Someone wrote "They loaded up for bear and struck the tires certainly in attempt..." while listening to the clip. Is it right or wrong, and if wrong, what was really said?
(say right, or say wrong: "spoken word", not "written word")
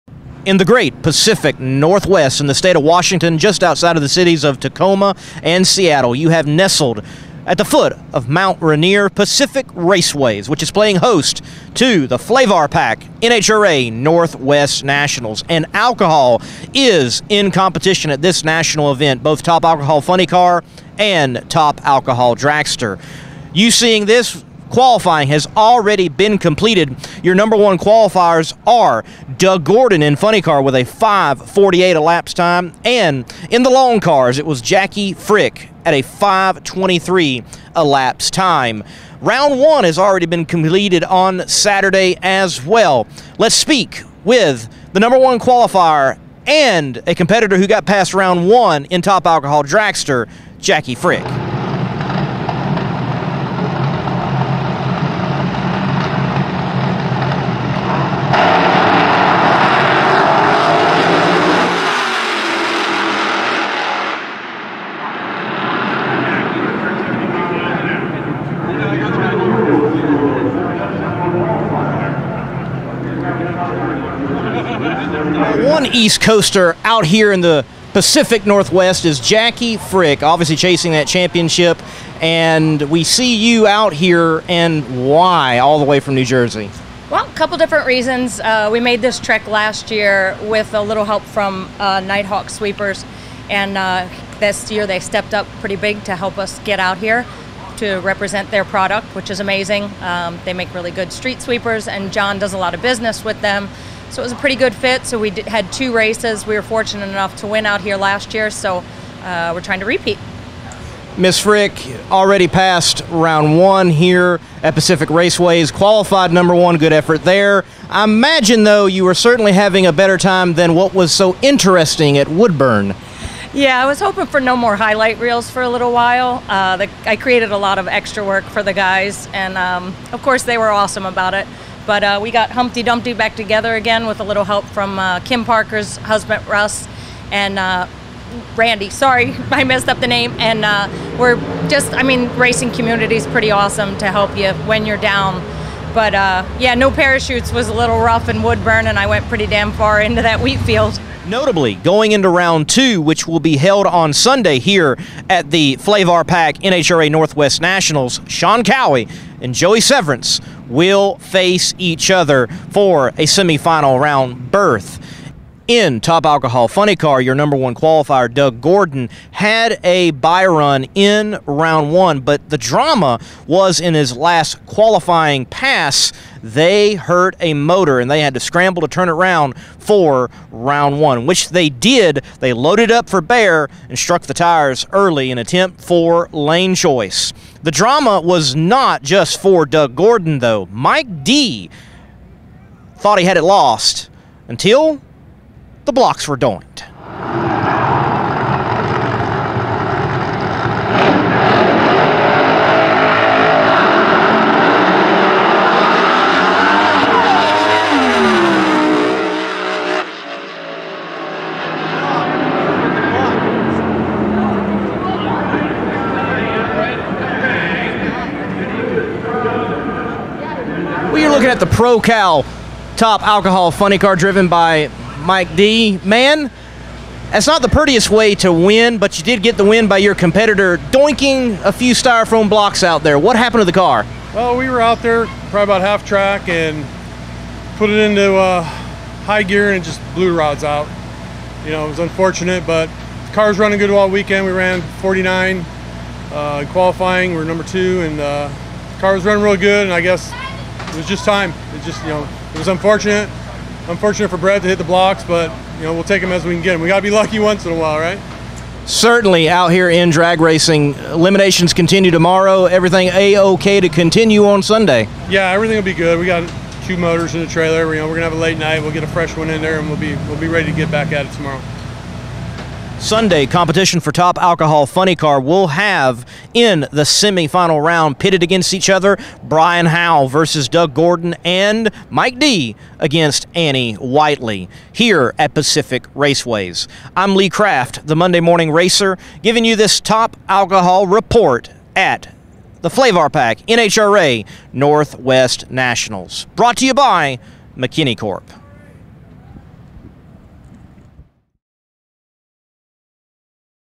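wrong: "early", not "certainly".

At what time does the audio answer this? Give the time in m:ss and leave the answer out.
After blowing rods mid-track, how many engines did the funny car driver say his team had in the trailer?
4:26.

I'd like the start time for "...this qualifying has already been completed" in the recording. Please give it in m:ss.
0:24.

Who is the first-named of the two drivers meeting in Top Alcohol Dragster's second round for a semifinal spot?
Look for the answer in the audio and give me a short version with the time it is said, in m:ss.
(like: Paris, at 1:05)
Sean Cowie, at 2:38.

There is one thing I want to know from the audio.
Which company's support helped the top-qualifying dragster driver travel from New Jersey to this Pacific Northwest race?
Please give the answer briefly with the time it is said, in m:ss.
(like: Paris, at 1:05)
Nighthawk Sweepers, at 1:32.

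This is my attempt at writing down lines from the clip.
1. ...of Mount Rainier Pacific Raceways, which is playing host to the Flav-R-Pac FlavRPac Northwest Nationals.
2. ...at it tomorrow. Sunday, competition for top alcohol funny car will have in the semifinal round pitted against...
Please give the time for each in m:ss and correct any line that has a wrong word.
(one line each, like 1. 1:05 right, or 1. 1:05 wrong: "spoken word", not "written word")
1. 0:08 wrong: "NHRA", not "FlavRPac"
2. 4:31 right.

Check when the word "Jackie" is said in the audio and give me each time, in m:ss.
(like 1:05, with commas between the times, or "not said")
0:34, 0:50, 1:19.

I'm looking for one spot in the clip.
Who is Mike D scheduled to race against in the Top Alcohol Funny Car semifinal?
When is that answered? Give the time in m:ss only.
4:43.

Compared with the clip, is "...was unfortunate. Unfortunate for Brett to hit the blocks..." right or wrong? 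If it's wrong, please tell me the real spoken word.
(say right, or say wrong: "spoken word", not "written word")
right.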